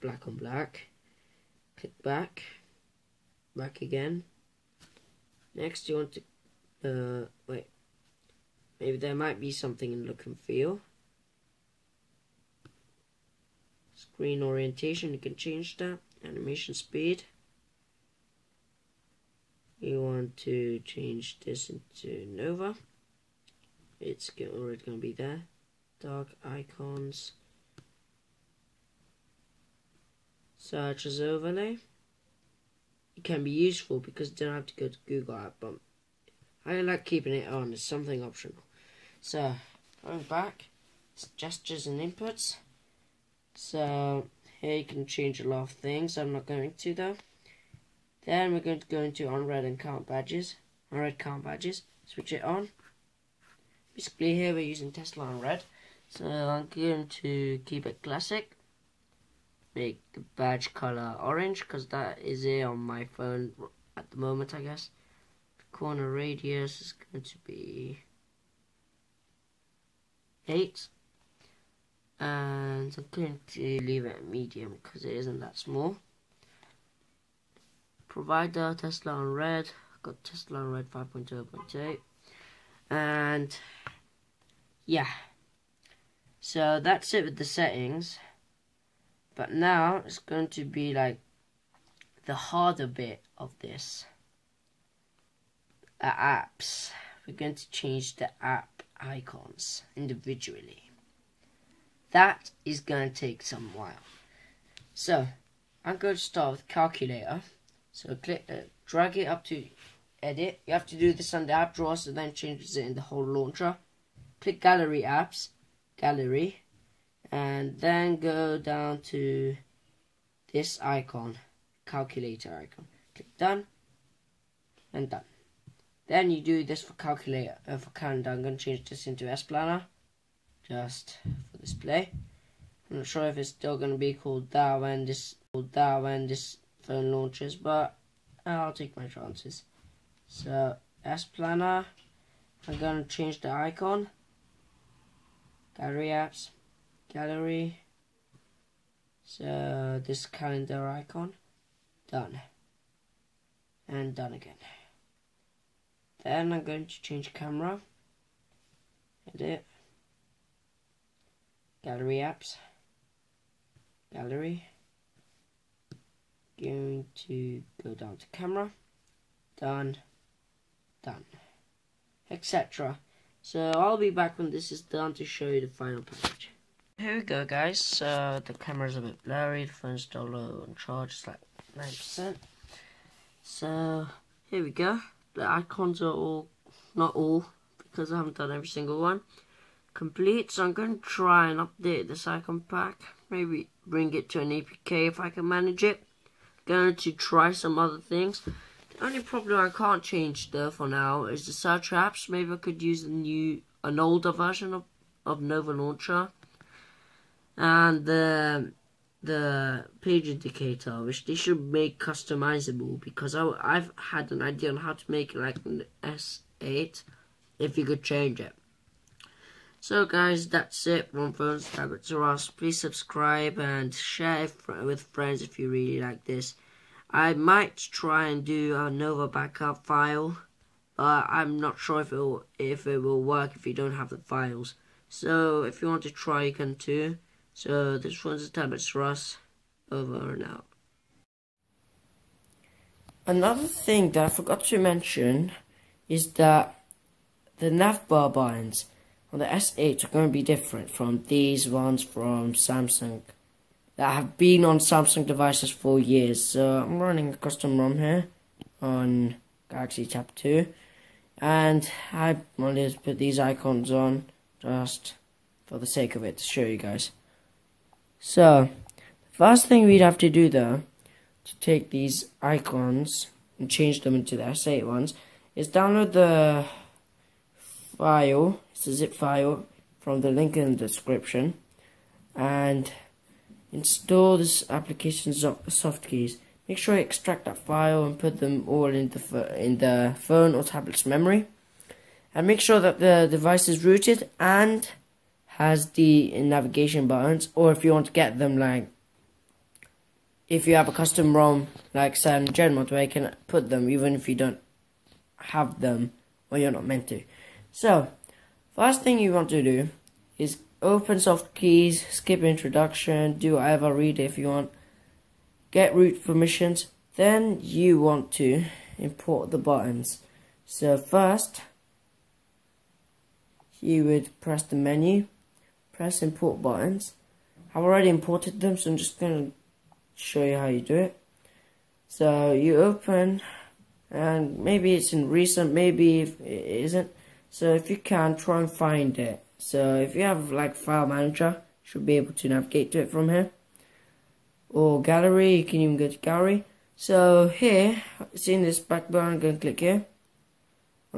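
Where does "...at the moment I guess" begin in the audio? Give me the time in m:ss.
1:03.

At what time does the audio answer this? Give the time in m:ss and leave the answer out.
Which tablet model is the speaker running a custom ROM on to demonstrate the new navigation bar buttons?
4:19.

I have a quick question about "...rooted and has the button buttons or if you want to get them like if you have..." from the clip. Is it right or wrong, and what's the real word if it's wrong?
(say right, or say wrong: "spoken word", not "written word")
wrong: "navigation", not "button".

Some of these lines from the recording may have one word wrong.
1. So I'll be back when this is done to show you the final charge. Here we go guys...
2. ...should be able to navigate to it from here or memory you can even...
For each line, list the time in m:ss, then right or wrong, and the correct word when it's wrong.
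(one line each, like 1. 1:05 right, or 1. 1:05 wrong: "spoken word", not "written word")
1. 2:53 wrong: "package", not "charge"
2. 5:41 wrong: "gallery", not "memory".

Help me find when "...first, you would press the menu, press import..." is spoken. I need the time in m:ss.
5:20.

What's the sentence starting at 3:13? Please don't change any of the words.
Maybe bring it to an APK if I can manage it.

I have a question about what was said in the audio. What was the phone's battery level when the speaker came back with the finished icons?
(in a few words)
9%.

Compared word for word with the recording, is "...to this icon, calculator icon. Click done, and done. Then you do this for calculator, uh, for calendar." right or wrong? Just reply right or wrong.
right.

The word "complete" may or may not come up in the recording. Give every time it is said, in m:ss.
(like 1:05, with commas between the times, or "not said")
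3:09.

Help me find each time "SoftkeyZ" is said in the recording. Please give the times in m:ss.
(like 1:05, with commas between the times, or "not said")
4:45, 5:11.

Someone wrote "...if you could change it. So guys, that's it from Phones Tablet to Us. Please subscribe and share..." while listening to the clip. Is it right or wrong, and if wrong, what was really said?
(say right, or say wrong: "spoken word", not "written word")
right.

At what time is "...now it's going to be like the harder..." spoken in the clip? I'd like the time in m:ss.
1:29.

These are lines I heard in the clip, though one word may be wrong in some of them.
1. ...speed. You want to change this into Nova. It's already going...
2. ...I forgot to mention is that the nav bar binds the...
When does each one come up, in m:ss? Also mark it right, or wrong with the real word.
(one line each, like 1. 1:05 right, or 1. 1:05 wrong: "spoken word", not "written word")
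1. 0:16 right
2. 4:04 right.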